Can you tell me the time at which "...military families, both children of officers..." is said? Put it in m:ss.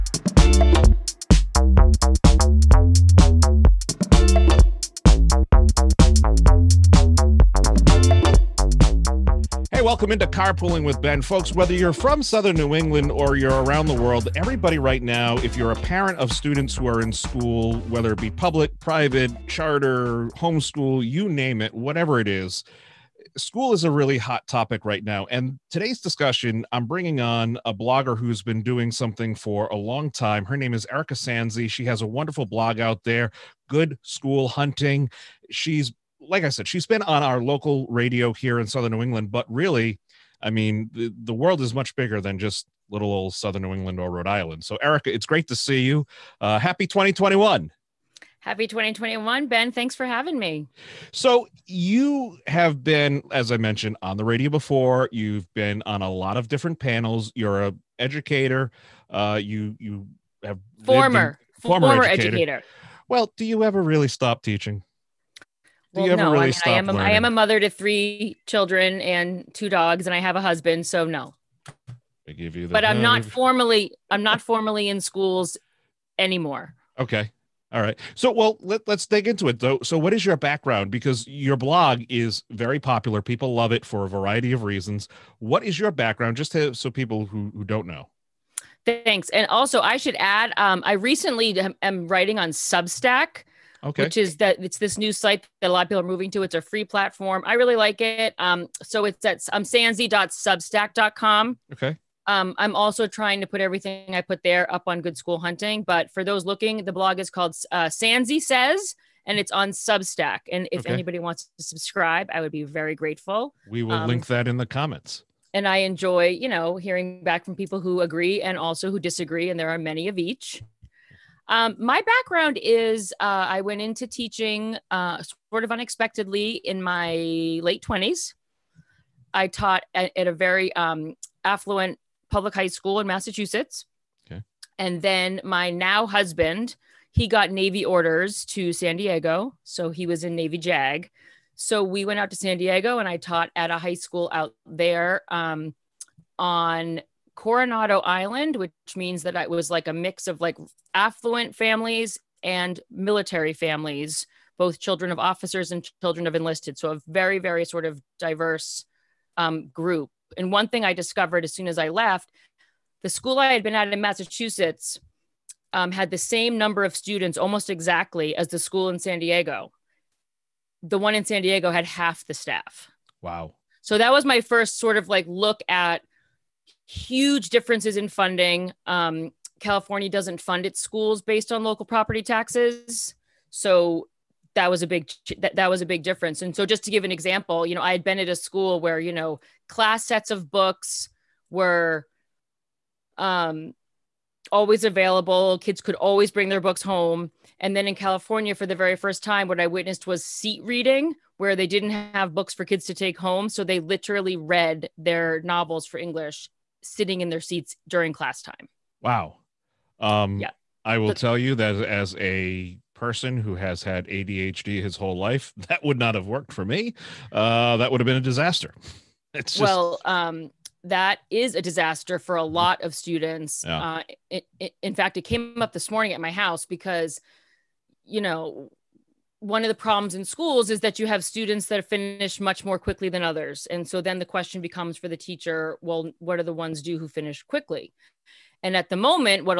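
2:32.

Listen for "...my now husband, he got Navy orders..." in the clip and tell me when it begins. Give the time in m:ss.
2:15.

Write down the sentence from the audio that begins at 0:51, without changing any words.
So, you have been, as I mentioned, on the radio before.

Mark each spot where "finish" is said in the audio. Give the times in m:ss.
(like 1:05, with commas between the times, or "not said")
3:51, 3:57.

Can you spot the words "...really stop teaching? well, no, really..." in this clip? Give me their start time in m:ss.
1:03.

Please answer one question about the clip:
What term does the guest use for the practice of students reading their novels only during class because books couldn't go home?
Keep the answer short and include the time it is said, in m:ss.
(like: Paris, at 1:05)
seat reading, at 3:20.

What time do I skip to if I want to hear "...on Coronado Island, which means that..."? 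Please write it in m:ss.
2:26.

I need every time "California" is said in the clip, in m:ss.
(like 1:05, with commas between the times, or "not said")
2:59, 3:17.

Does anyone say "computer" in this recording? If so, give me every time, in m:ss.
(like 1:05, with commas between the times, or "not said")
not said.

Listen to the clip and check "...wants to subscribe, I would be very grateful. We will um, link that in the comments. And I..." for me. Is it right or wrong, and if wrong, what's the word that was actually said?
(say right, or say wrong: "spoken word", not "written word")
right.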